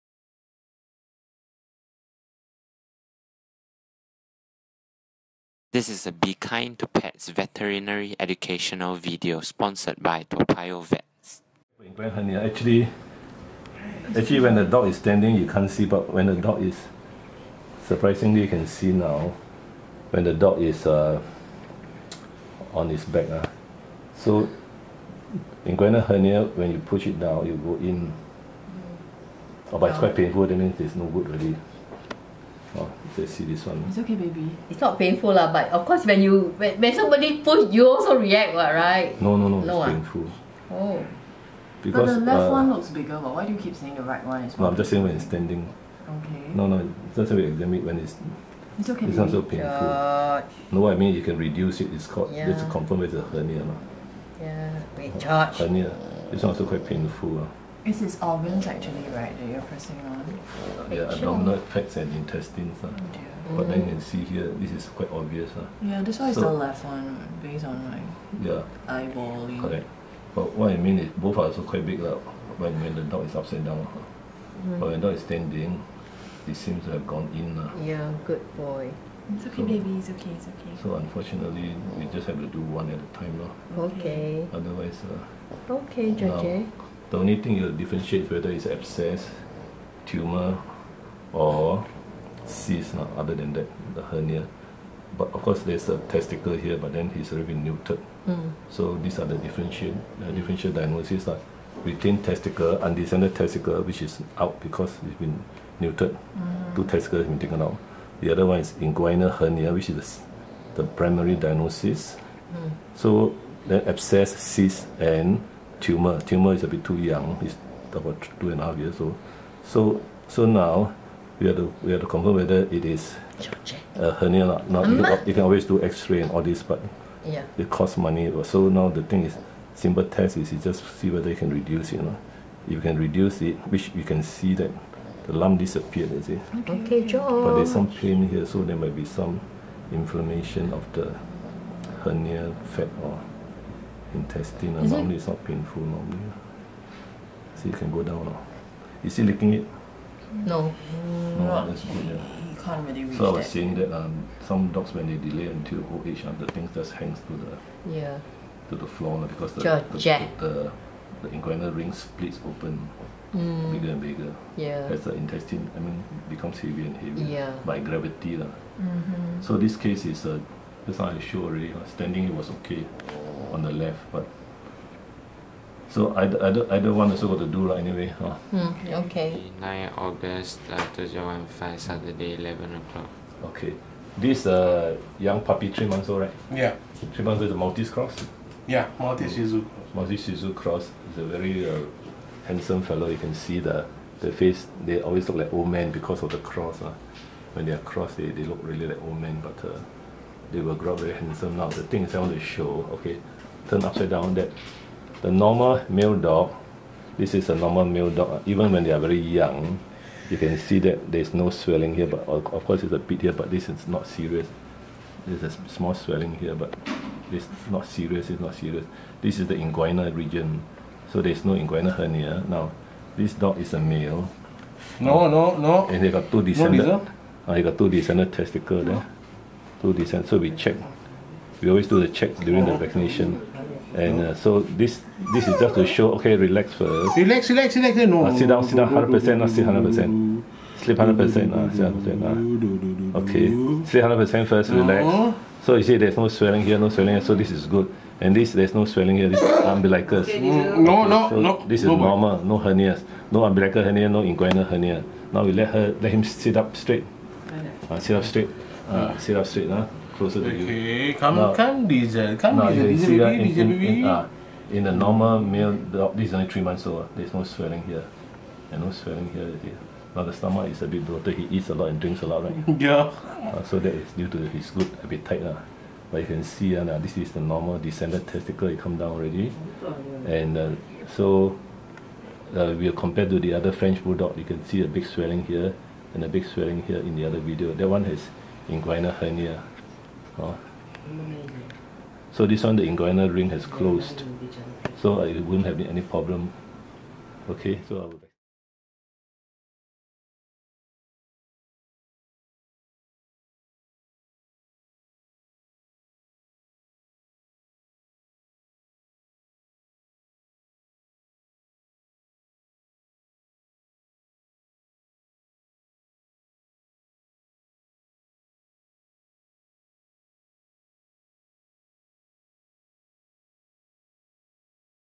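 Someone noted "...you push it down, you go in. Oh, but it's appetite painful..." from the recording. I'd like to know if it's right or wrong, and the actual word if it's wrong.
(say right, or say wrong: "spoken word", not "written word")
wrong: "quite", not "appetite".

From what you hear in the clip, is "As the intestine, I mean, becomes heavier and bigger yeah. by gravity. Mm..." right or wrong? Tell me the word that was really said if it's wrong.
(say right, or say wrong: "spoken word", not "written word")
wrong: "heavier", not "bigger".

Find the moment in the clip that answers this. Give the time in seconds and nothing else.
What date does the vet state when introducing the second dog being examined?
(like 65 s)
179 s.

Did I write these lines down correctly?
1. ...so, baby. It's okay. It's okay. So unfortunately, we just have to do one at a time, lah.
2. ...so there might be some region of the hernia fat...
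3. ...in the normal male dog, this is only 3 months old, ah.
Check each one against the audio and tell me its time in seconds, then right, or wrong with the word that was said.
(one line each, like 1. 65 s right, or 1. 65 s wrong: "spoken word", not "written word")
1. 79 s right
2. 138 s wrong: "inflammation", not "region"
3. 264 s right.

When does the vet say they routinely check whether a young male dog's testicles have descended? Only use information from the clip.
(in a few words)
During the vaccination.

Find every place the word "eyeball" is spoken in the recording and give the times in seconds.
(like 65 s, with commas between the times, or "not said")
68 s.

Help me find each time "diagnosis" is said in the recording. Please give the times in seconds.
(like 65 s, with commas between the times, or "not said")
100 s, 111 s.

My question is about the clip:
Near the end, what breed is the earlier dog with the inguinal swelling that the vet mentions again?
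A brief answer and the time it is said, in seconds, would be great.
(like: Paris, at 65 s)
French Bulldog, at 283 s.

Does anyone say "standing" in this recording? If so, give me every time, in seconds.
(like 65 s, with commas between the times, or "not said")
14 s, 45 s, 75 s, 171 s.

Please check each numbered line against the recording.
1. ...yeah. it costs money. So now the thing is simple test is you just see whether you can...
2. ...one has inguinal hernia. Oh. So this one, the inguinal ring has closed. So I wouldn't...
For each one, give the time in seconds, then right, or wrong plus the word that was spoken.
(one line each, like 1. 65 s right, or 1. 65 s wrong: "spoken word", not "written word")
1. 127 s right
2. 287 s right.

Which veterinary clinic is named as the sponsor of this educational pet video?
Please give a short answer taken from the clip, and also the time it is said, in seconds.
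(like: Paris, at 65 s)
Toa Payoh Vets, at 10 s.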